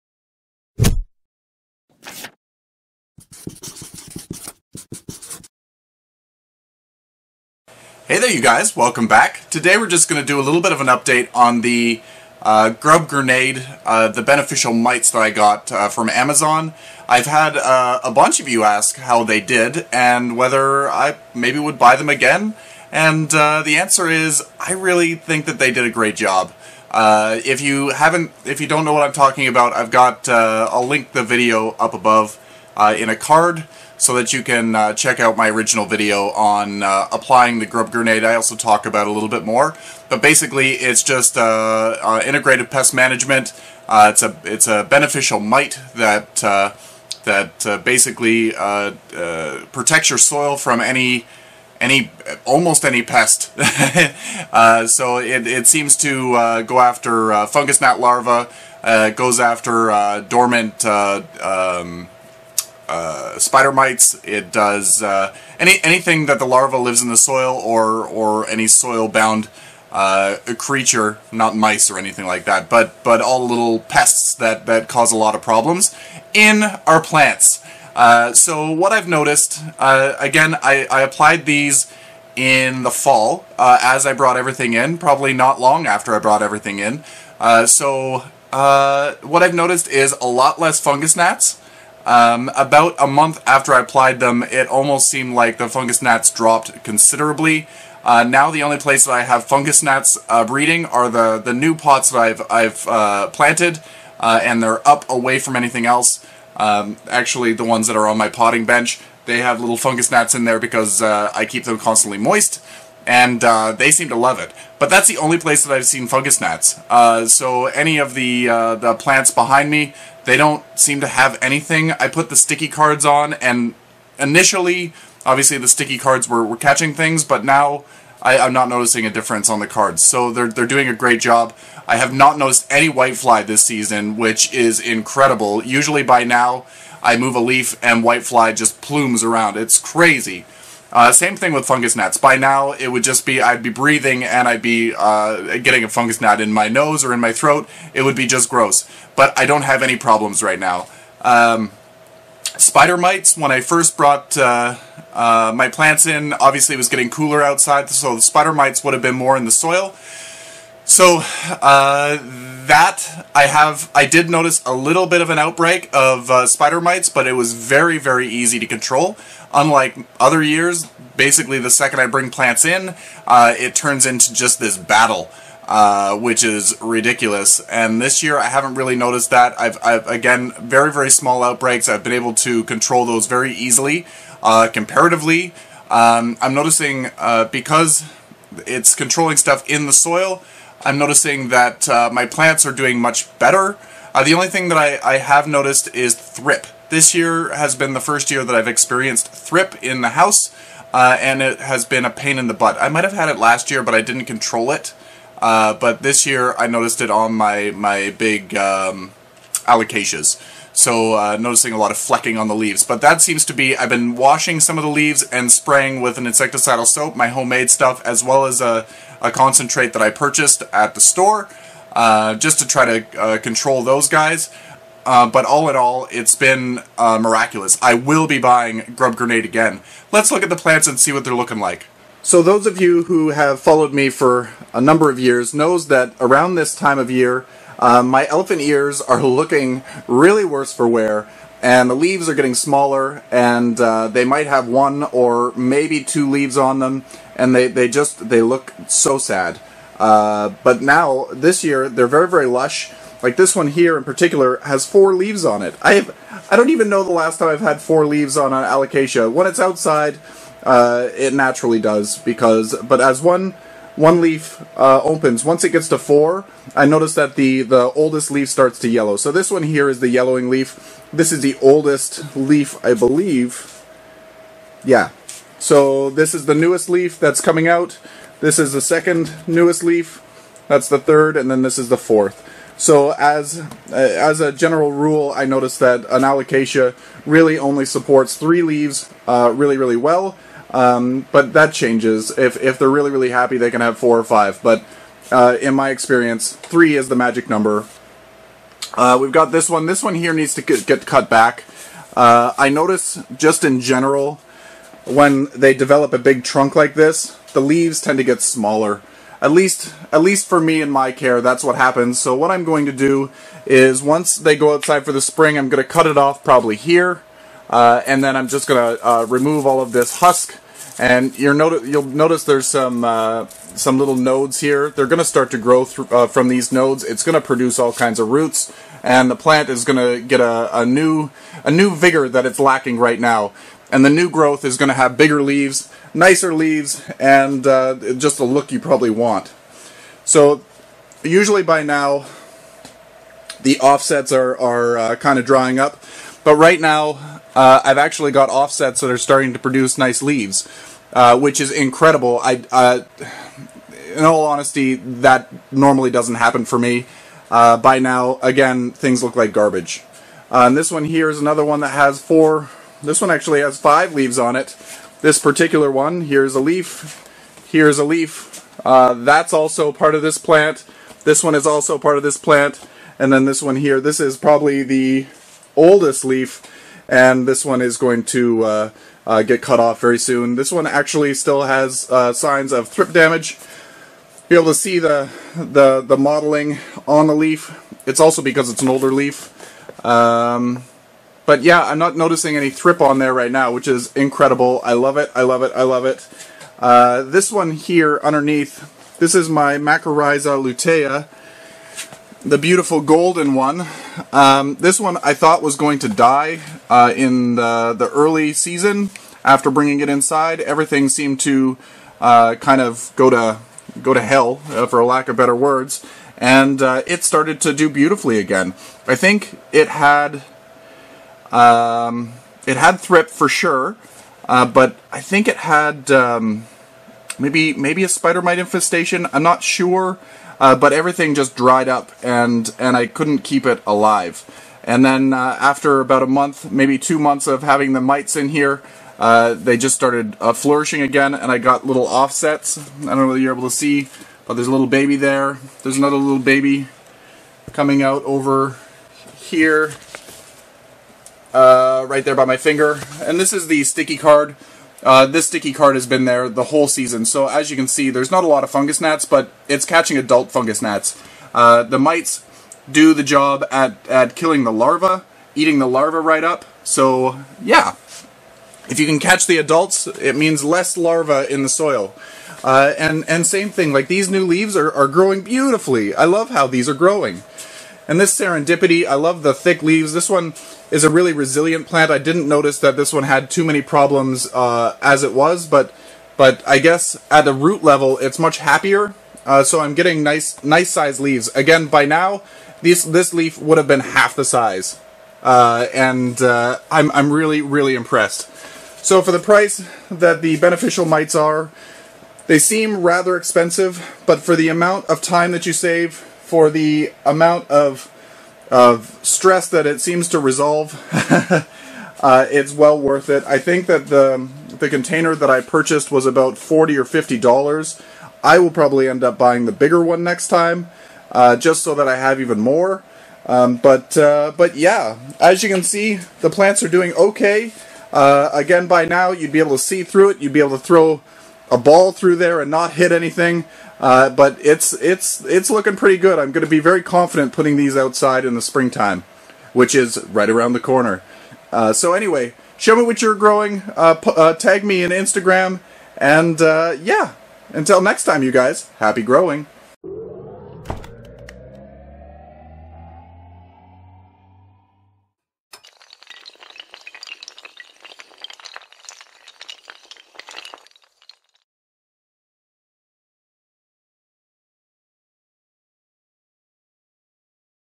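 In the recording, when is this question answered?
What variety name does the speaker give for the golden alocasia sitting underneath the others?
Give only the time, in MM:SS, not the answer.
06:39.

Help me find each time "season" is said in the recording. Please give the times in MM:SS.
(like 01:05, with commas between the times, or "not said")
02:13, 06:48, 07:36.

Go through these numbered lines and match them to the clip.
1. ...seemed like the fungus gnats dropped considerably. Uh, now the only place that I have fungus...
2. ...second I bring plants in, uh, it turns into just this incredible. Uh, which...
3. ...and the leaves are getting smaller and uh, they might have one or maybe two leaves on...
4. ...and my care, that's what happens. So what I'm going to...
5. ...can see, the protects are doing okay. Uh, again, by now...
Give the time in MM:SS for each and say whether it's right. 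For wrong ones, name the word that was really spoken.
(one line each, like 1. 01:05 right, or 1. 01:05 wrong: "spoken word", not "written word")
1. 01:35 right
2. 02:51 wrong: "battle", not "incredible"
3. 04:01 right
4. 05:10 right
5. 08:45 wrong: "plants", not "protects".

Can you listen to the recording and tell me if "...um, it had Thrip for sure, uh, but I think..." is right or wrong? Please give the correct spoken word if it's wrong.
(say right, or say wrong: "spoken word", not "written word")
right.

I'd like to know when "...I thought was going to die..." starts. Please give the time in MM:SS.
06:45.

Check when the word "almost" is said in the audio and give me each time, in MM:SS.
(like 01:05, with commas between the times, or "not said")
00:52, 01:34.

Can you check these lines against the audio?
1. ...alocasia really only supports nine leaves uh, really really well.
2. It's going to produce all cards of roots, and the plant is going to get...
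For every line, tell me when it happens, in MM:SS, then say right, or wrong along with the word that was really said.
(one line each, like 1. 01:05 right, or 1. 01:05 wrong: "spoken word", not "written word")
1. 04:46 wrong: "three", not "nine"
2. 05:27 wrong: "kinds", not "cards".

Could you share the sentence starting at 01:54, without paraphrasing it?
But that's the only place that I've seen fungus gnats.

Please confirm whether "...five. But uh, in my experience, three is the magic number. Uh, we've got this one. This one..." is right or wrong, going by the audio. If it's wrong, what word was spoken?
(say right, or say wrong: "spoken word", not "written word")
right.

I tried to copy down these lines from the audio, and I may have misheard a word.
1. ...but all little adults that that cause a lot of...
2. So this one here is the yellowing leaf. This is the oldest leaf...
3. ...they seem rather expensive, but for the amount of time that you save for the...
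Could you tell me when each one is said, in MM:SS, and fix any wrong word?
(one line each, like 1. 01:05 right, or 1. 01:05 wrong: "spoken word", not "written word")
1. 01:13 wrong: "pests", not "adults"
2. 04:29 right
3. 08:22 right.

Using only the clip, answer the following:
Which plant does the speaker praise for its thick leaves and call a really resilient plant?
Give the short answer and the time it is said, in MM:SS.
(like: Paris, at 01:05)
serendipity, at 07:58.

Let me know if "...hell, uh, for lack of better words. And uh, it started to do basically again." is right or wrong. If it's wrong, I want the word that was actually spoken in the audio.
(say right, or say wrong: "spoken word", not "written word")
wrong: "beautifully", not "basically".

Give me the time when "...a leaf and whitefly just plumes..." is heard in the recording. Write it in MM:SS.
02:17.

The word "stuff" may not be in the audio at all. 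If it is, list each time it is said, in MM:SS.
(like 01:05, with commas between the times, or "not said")
03:09, 03:37.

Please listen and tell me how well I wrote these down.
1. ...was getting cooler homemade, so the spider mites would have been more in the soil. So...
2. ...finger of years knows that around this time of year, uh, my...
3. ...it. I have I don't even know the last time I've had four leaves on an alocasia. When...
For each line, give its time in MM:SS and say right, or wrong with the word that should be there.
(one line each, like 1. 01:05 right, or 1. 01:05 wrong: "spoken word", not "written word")
1. 02:36 wrong: "outside", not "homemade"
2. 03:54 wrong: "number", not "finger"
3. 04:15 right.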